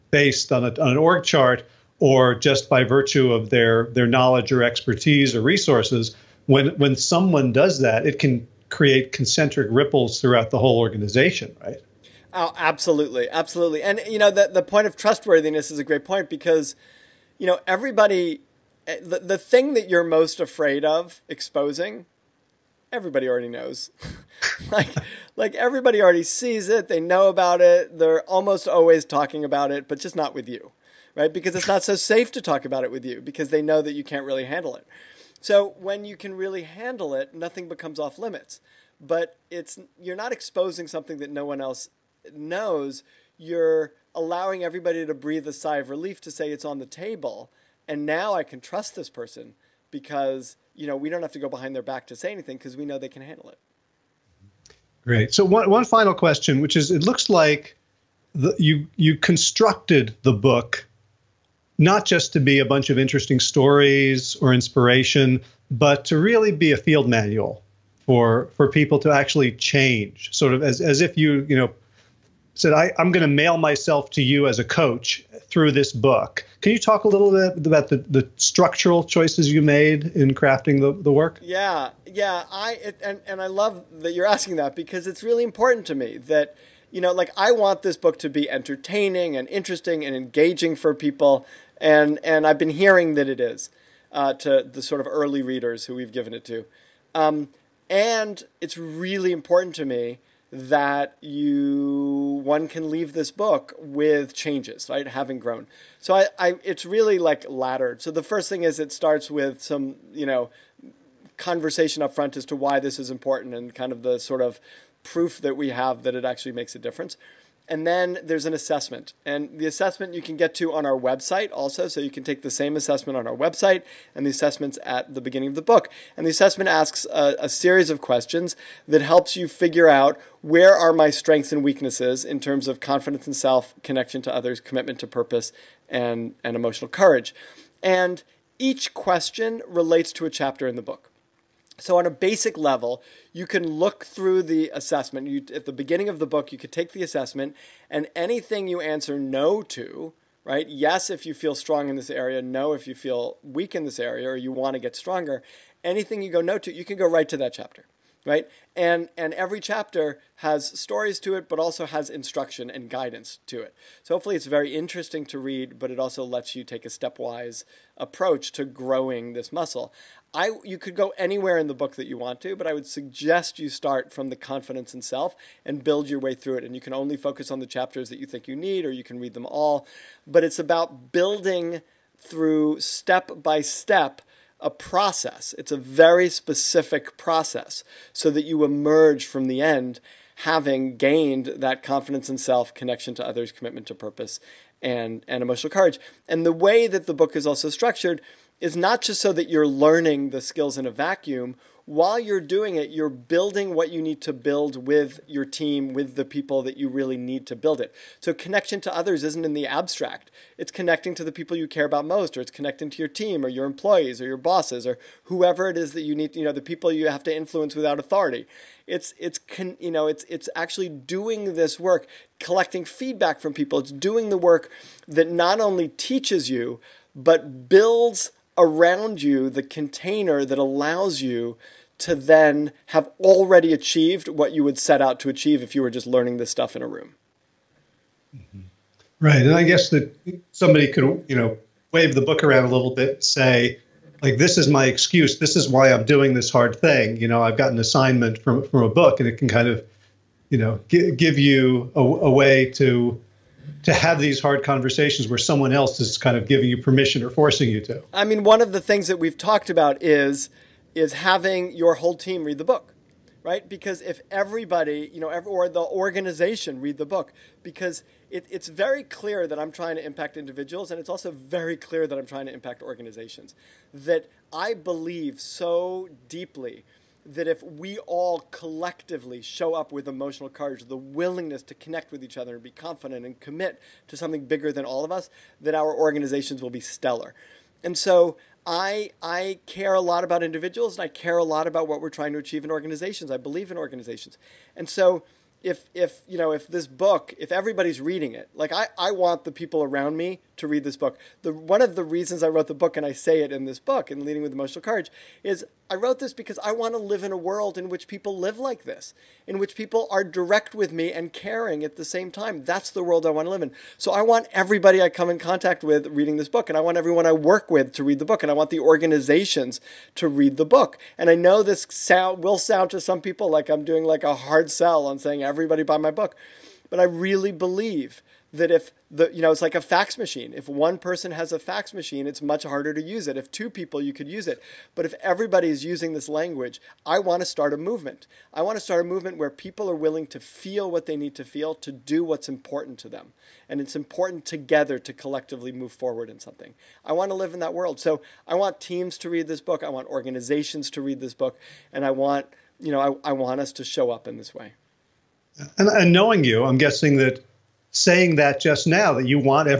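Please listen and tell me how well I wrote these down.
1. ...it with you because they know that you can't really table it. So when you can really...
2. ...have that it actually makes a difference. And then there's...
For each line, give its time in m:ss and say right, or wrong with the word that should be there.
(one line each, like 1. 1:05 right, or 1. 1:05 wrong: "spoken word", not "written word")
1. 0:32 wrong: "handle", not "table"
2. 1:55 right.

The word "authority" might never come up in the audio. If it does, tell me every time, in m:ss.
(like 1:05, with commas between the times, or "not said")
3:37.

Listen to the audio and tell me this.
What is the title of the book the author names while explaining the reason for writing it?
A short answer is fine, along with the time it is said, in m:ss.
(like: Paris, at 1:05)
Leading with Emotional Courage, at 5:04.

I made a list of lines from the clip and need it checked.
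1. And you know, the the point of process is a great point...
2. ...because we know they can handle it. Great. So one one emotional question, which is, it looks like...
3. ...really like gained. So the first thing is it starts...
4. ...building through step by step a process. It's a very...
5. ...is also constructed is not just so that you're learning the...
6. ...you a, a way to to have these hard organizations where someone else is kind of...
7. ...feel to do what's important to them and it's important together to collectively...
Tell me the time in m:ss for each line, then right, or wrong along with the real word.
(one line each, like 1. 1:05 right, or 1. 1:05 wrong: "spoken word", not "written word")
1. 0:13 wrong: "trustworthiness", not "process"
2. 0:52 wrong: "final", not "emotional"
3. 1:46 wrong: "laddered", not "gained"
4. 3:01 right
5. 3:17 wrong: "structured", not "constructed"
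6. 4:11 wrong: "conversations", not "organizations"
7. 5:41 right.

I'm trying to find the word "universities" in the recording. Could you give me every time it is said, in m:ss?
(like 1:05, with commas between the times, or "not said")
not said.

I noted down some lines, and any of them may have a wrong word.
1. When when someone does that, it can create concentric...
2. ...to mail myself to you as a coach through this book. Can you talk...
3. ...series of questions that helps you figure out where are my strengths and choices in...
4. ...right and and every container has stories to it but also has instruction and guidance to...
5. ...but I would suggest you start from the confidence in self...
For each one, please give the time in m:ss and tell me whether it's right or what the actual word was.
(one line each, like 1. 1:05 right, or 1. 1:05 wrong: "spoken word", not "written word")
1. 0:06 right
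2. 1:13 right
3. 2:07 wrong: "weaknesses", not "choices"
4. 2:38 wrong: "chapter", not "container"
5. 2:52 right.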